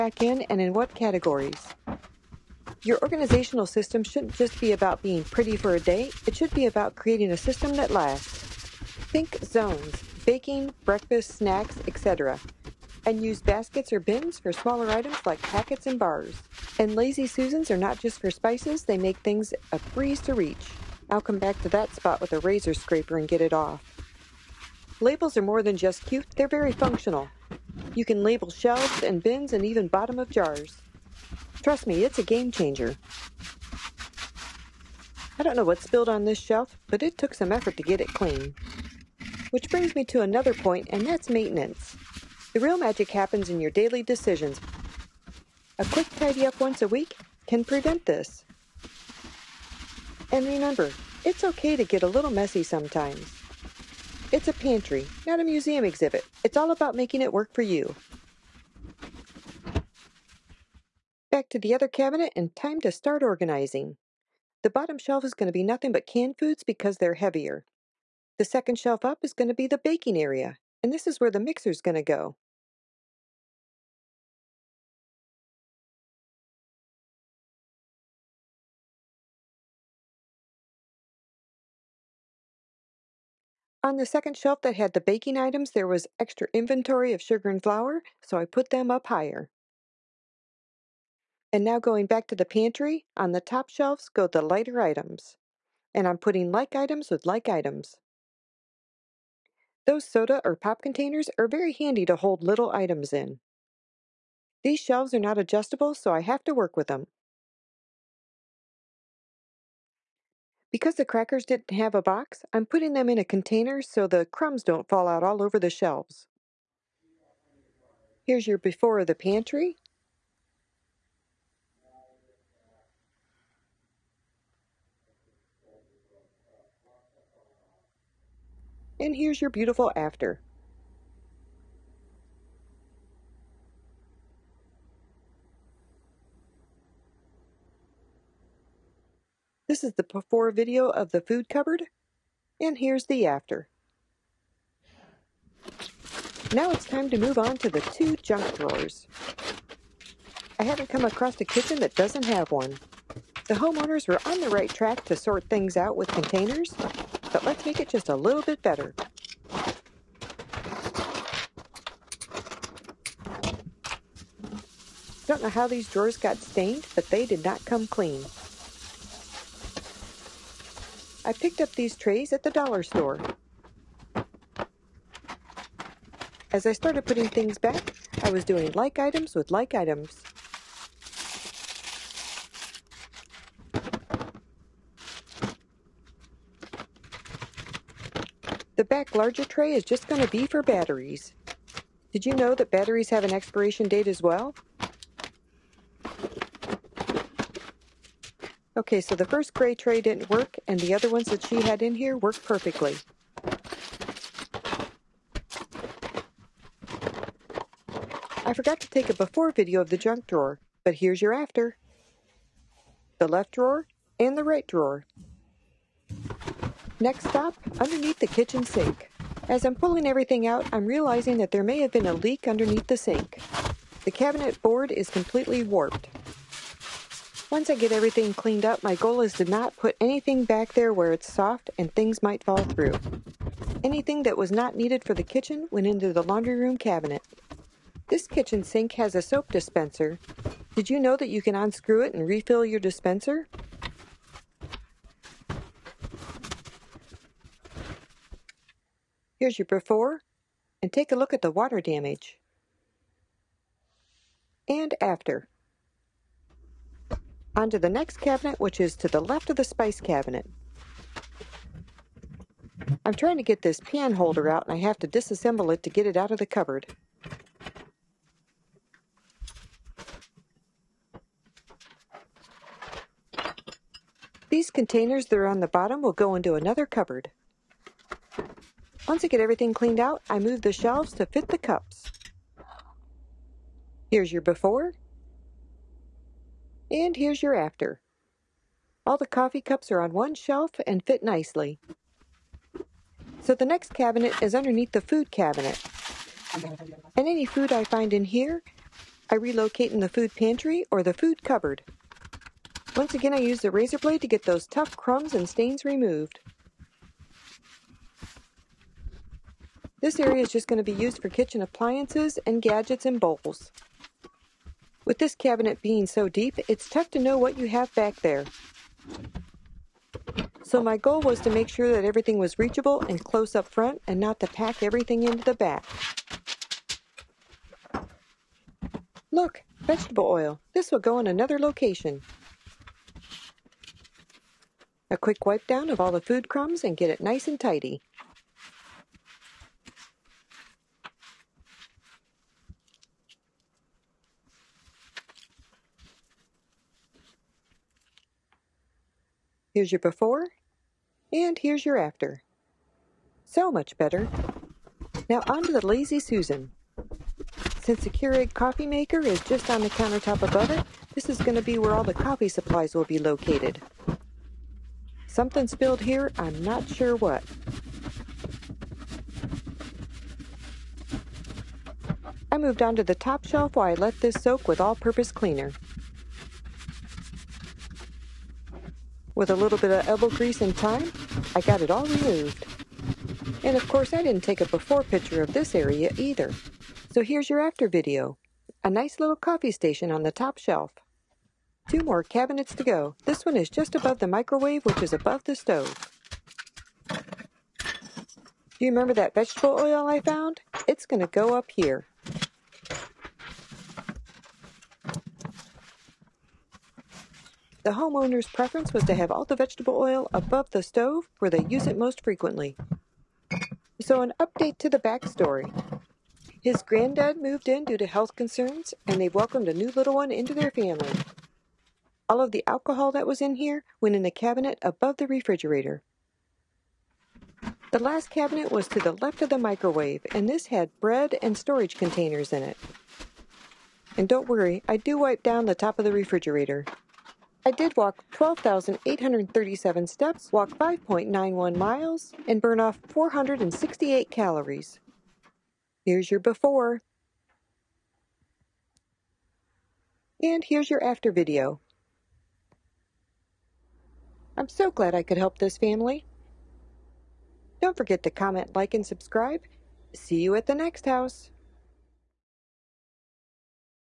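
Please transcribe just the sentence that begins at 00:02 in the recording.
Your organizational system shouldn't just be about being pretty for a day, it should be about creating a system that lasts.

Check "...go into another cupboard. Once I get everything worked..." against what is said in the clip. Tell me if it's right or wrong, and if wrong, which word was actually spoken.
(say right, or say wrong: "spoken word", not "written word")
wrong: "cleaned", not "worked".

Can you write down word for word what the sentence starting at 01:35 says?
And I'm putting like items with like items.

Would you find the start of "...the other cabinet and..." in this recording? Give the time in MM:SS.
01:01.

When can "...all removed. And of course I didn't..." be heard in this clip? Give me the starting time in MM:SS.
06:21.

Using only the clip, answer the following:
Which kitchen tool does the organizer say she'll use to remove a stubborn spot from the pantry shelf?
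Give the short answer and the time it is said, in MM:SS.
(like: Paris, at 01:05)
Razor scraper, at 00:22.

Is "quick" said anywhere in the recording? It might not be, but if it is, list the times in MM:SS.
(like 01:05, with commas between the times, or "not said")
00:45, 05:35.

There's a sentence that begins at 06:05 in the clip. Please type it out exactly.
Something spilled here, I'm not sure what.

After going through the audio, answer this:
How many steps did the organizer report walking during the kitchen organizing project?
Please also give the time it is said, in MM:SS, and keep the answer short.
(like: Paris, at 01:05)
12,837, at 07:18.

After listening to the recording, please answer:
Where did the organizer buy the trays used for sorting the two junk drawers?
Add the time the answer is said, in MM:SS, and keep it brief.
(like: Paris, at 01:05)
The dollar store, at 02:52.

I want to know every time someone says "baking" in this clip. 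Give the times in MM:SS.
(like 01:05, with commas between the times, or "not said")
00:10, 01:09, 01:24.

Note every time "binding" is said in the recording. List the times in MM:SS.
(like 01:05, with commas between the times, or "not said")
not said.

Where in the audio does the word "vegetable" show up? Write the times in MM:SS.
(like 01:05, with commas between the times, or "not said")
05:29, 06:39, 06:49.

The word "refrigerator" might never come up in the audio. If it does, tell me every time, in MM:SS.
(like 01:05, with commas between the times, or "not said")
07:05, 07:16.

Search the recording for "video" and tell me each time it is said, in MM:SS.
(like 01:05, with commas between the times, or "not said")
02:20, 03:29, 06:27, 07:31.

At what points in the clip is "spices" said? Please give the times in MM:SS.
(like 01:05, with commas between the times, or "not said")
00:18, 04:19.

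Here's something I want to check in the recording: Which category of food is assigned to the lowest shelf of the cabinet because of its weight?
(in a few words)
Canned foods.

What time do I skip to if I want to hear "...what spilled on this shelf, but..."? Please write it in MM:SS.
00:35.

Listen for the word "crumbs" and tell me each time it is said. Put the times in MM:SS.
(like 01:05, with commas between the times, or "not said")
01:54, 05:04, 05:36.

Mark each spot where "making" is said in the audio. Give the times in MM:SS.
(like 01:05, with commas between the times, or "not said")
00:56.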